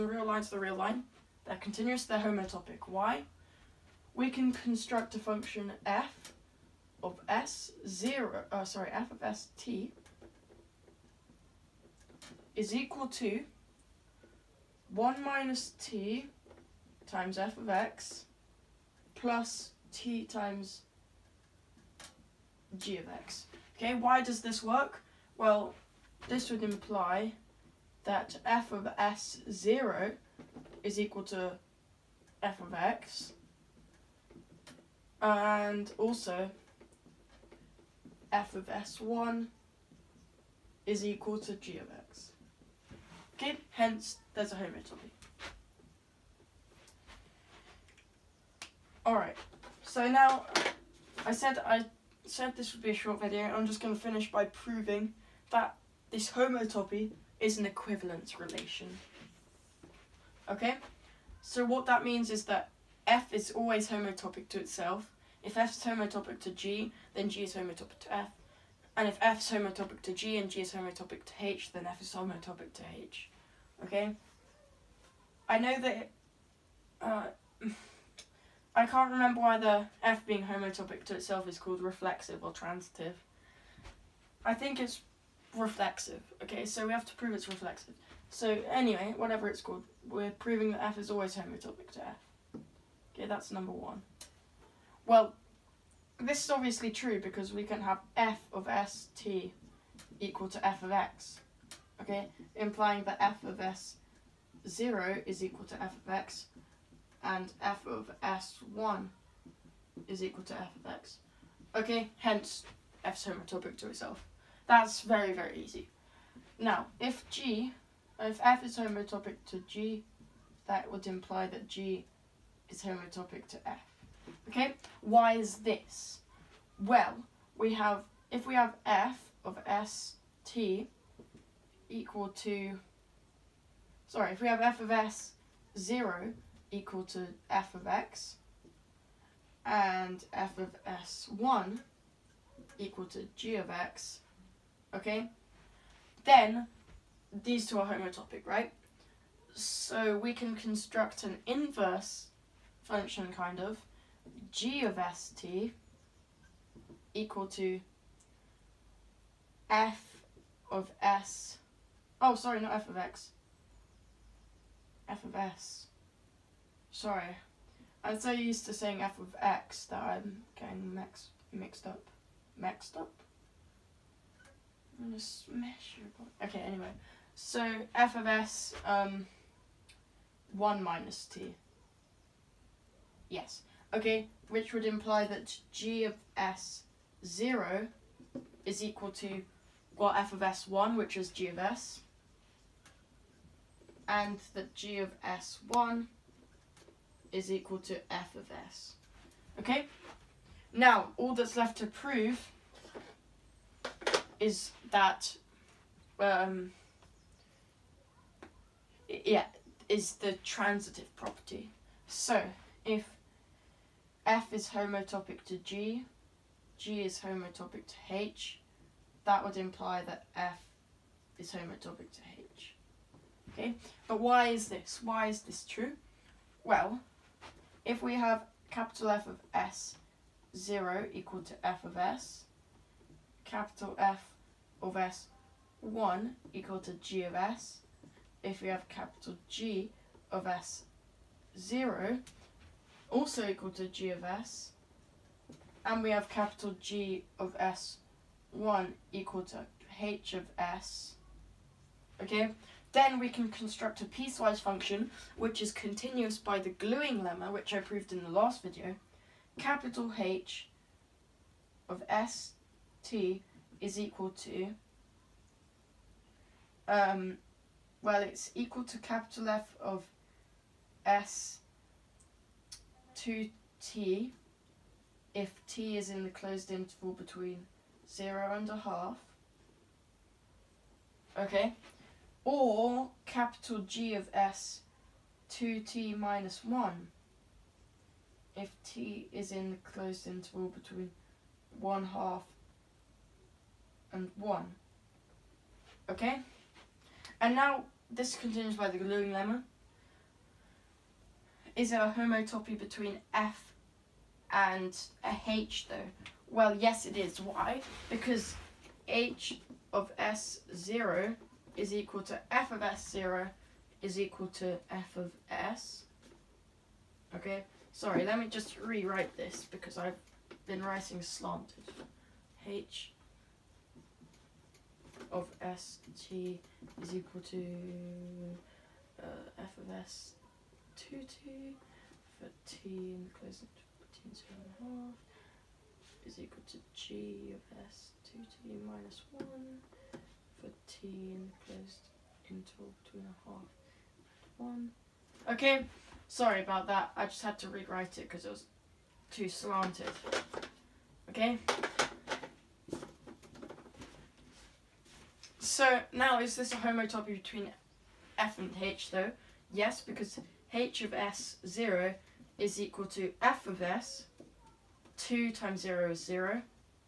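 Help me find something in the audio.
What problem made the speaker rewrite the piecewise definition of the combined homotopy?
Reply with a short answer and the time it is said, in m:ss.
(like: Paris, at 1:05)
Too slanted, at 5:48.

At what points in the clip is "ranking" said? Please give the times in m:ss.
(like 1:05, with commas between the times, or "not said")
not said.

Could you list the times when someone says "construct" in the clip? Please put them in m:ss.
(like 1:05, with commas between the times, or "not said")
0:04, 2:30, 4:13.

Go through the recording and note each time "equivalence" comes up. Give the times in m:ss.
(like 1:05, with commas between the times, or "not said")
0:57.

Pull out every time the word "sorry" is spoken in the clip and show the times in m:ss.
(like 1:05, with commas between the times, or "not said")
0:08, 2:14, 2:42, 2:46, 5:17, 5:46.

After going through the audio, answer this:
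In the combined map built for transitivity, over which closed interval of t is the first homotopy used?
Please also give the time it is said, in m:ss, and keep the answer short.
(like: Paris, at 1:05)
0 to 1/2, at 4:37.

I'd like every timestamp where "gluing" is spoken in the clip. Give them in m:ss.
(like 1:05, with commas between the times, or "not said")
4:16, 4:58.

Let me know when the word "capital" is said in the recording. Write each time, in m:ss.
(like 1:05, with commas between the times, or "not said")
3:48, 3:53, 3:58, 4:06, 4:19, 4:28, 4:43.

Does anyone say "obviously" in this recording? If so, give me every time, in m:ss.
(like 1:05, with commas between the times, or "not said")
1:36.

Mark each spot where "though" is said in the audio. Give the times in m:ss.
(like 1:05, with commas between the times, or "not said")
5:05, 5:59.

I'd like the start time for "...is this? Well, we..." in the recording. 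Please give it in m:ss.
2:05.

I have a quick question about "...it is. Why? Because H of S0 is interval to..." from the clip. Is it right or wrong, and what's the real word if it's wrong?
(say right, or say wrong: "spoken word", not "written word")
wrong: "equal", not "interval".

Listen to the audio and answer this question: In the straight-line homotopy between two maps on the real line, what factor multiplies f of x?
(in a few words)
1 minus t.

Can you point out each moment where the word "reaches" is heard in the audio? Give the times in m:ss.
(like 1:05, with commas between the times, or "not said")
not said.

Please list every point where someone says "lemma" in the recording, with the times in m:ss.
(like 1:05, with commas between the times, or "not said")
4:17, 4:59.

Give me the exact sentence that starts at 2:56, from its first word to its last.
okay anyway so f of s um 1 minus t Yes.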